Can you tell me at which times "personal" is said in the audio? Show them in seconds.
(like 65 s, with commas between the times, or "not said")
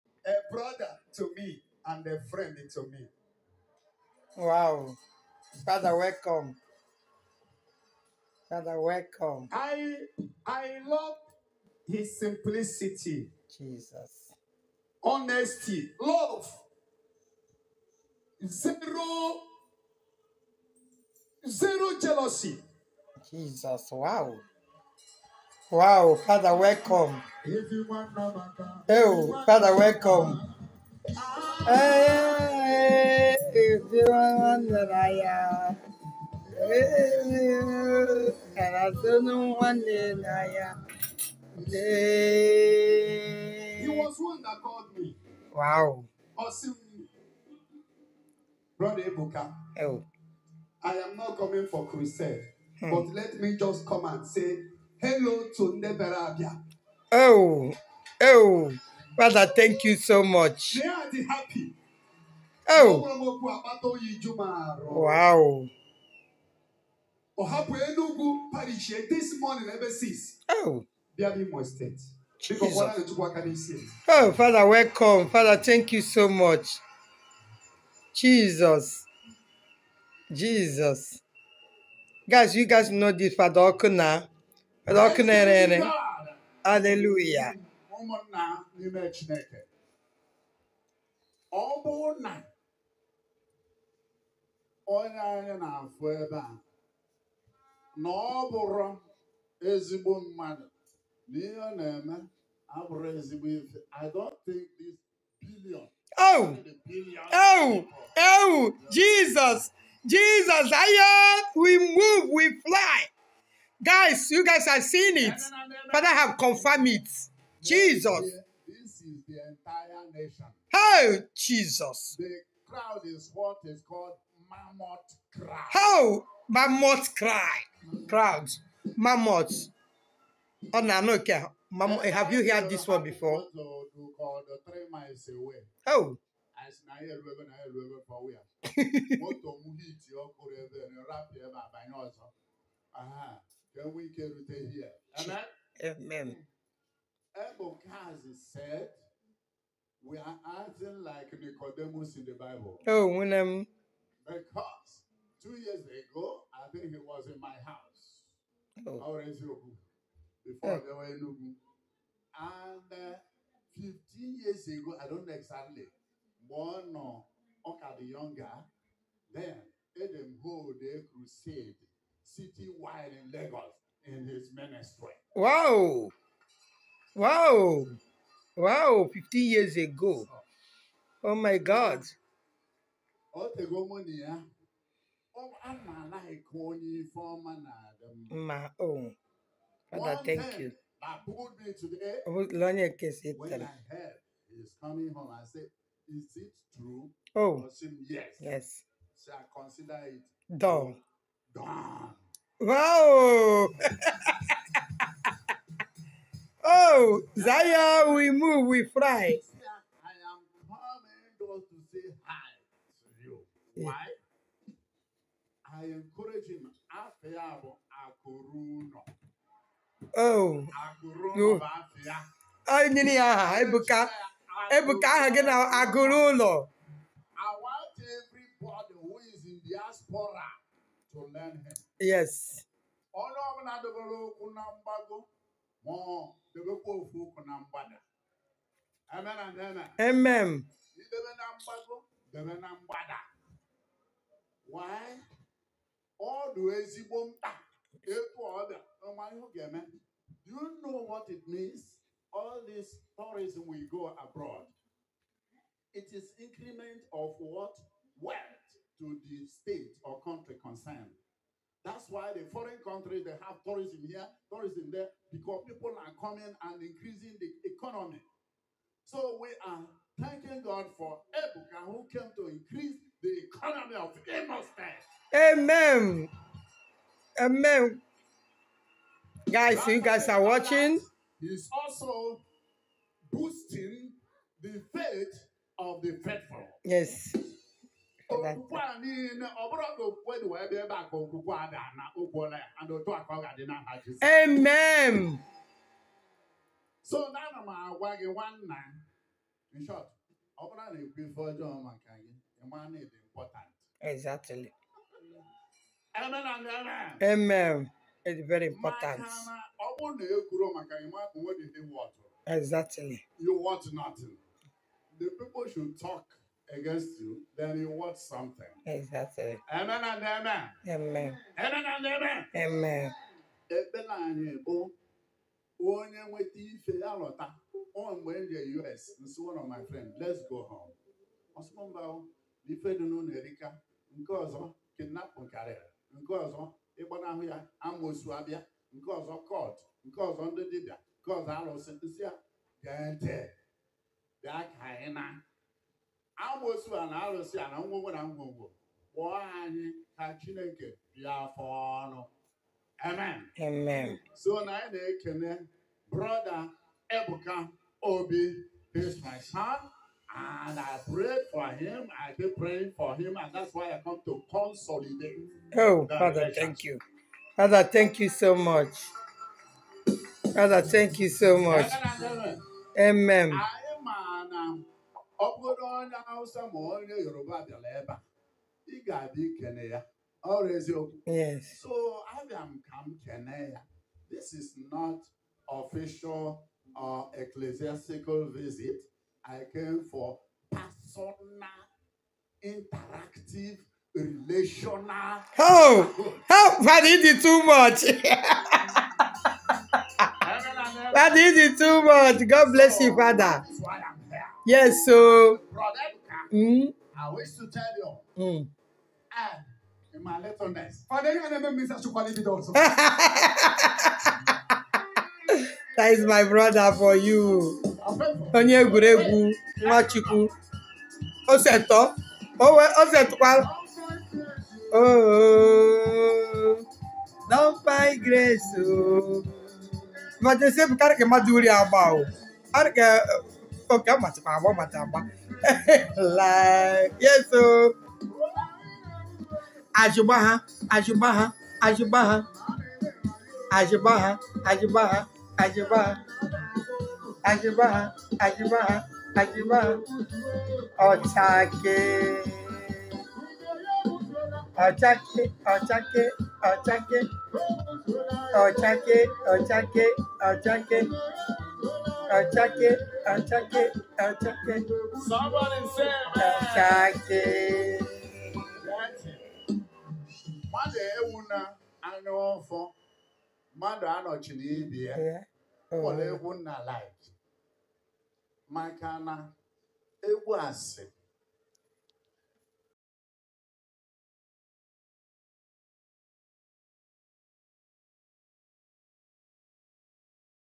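390 s.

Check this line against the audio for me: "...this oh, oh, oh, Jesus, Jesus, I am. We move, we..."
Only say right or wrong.
right.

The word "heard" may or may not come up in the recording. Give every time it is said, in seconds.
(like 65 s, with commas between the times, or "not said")
132 s, 192 s.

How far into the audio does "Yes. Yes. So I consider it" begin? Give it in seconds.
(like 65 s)
198 s.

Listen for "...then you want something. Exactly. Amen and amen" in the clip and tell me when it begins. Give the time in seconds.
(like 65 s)
317 s.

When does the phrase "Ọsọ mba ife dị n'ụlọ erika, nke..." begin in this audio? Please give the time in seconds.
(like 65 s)
331 s.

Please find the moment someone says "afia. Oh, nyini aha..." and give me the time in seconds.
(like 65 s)
221 s.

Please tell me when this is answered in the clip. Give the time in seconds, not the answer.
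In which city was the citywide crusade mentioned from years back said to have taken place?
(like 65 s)
173 s.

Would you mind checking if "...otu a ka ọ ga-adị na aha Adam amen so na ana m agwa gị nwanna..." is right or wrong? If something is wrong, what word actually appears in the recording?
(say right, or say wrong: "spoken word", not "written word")
wrong: "Jizọs", not "Adam".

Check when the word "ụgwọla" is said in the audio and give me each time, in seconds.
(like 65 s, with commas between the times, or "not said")
292 s.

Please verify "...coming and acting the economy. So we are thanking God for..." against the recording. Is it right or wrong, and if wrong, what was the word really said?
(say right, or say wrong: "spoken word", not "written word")
wrong: "increasing", not "acting".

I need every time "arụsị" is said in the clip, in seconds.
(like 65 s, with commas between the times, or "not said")
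341 s, 347 s.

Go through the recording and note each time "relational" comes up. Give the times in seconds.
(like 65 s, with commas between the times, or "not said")
394 s.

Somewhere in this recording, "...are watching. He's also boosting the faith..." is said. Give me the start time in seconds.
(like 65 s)
280 s.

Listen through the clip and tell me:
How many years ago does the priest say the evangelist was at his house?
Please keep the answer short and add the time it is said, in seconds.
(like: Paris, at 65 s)
2, at 155 s.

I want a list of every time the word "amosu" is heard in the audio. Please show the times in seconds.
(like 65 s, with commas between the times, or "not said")
337 s, 346 s.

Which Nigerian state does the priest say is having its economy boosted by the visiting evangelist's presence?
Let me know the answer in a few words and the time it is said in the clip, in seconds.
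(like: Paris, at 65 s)
Imo State, at 274 s.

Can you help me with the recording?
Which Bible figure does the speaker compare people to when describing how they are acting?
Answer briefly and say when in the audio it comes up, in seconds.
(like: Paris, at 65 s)
Nicodemus, at 151 s.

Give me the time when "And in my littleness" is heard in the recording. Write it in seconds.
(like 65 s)
409 s.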